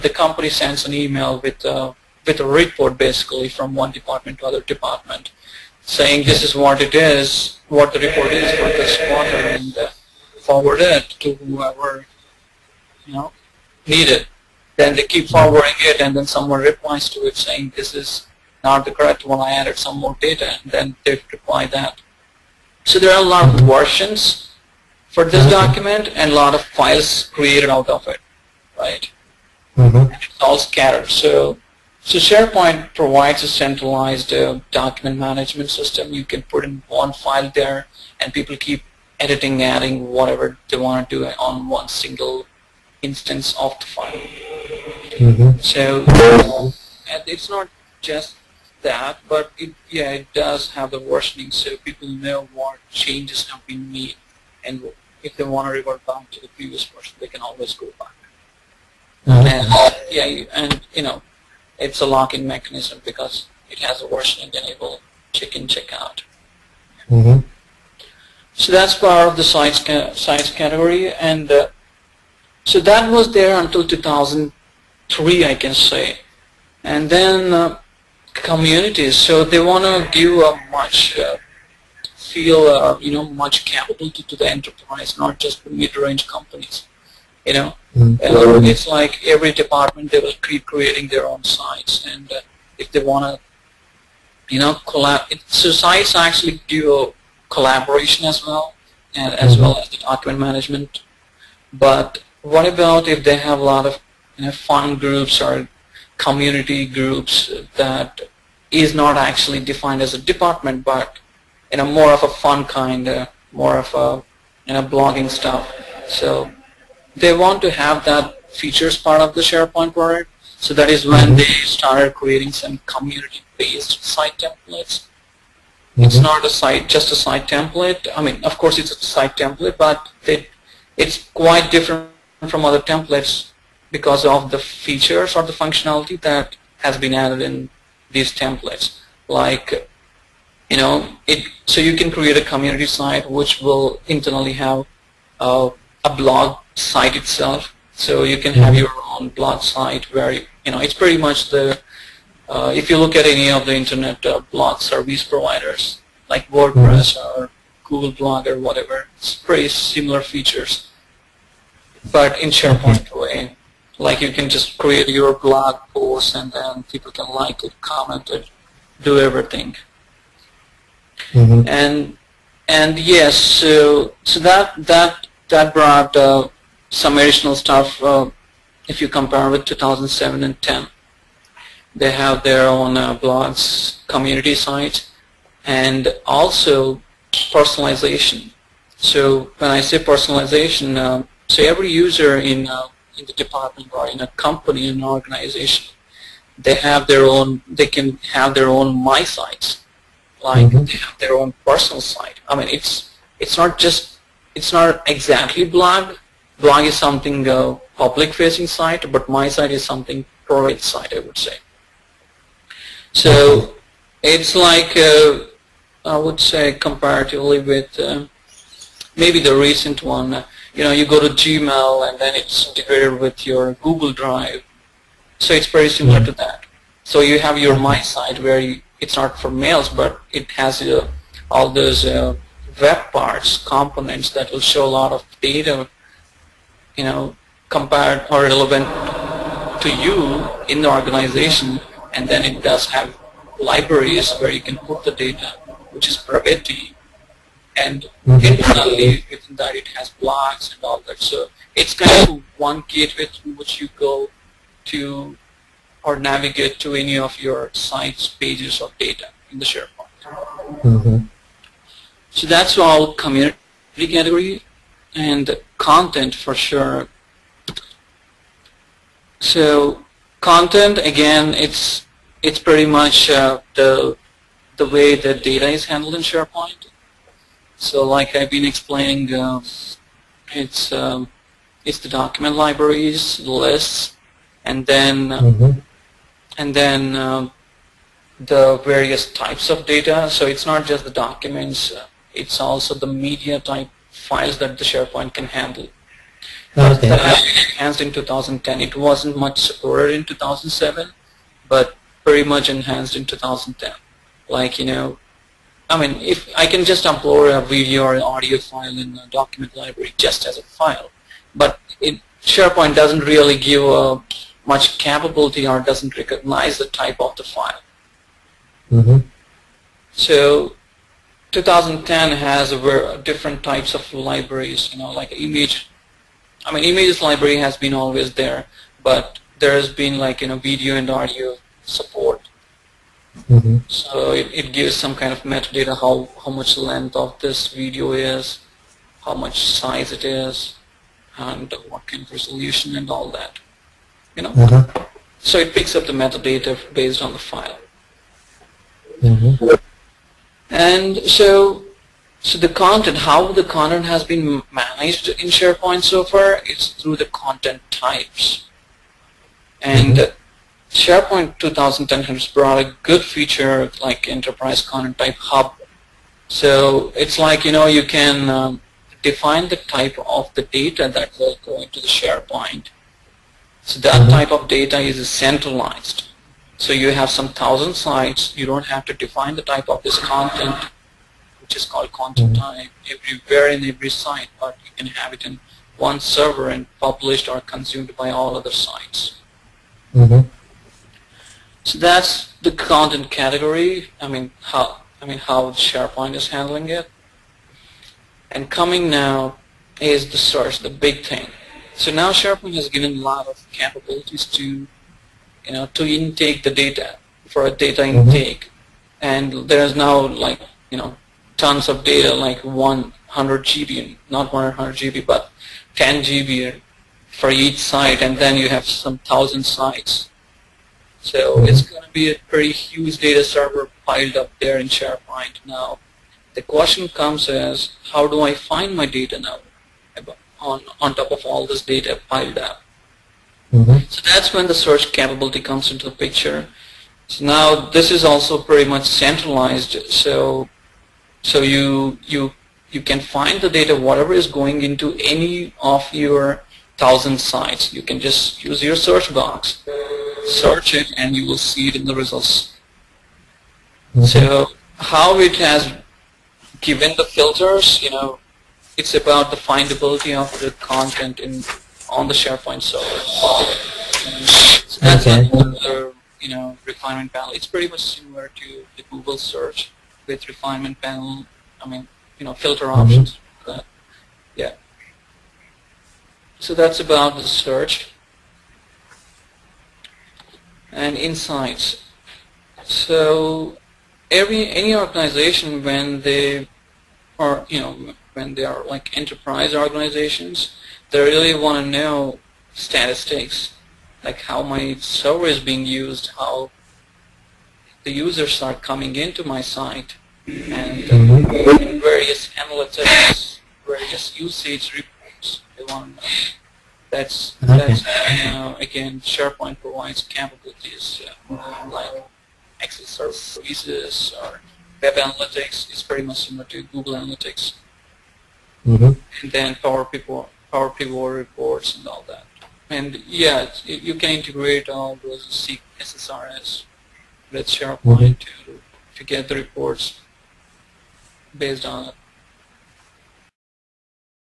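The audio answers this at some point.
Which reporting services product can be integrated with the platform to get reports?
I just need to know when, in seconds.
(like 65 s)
525 s.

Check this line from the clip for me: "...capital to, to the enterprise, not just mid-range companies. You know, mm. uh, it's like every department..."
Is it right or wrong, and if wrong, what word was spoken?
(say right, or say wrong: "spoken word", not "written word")
right.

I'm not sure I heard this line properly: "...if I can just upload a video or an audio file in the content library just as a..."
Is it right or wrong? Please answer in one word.
wrong.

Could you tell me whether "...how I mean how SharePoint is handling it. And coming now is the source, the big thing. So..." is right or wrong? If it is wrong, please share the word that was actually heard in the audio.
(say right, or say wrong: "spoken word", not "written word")
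right.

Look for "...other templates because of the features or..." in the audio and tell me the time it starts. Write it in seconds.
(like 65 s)
132 s.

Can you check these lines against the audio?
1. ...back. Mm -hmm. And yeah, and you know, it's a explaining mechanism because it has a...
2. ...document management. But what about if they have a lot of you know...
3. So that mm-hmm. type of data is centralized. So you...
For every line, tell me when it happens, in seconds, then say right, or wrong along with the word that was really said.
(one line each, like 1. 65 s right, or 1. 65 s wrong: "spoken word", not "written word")
1. 58 s wrong: "locking", not "explaining"
2. 99 s right
3. 373 s right.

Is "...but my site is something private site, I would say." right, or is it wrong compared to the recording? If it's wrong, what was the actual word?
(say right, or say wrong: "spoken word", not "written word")
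right.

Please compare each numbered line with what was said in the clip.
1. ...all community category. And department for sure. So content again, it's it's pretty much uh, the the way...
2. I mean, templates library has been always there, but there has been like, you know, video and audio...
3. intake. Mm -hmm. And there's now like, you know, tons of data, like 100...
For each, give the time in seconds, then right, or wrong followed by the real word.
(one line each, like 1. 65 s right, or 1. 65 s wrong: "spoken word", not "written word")
1. 262 s wrong: "content", not "department"
2. 326 s wrong: "images", not "templates"
3. 408 s right.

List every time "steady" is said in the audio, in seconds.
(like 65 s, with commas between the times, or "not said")
not said.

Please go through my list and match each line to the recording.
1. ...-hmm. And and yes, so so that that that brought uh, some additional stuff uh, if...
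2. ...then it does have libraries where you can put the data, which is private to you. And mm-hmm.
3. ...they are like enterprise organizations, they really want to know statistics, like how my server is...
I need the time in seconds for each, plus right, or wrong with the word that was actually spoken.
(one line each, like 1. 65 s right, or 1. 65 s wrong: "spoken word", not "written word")
1. 171 s right
2. 242 s right
3. 488 s right.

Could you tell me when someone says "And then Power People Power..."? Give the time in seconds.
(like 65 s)
519 s.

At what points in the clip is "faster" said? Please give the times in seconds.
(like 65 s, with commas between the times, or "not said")
not said.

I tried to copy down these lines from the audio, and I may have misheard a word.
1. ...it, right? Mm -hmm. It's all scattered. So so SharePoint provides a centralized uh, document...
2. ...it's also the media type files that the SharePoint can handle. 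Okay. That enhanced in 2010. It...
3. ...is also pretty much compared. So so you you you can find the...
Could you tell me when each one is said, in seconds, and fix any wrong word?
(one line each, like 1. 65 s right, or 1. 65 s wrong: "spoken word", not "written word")
1. 28 s right
2. 292 s right
3. 438 s wrong: "centralized", not "compared".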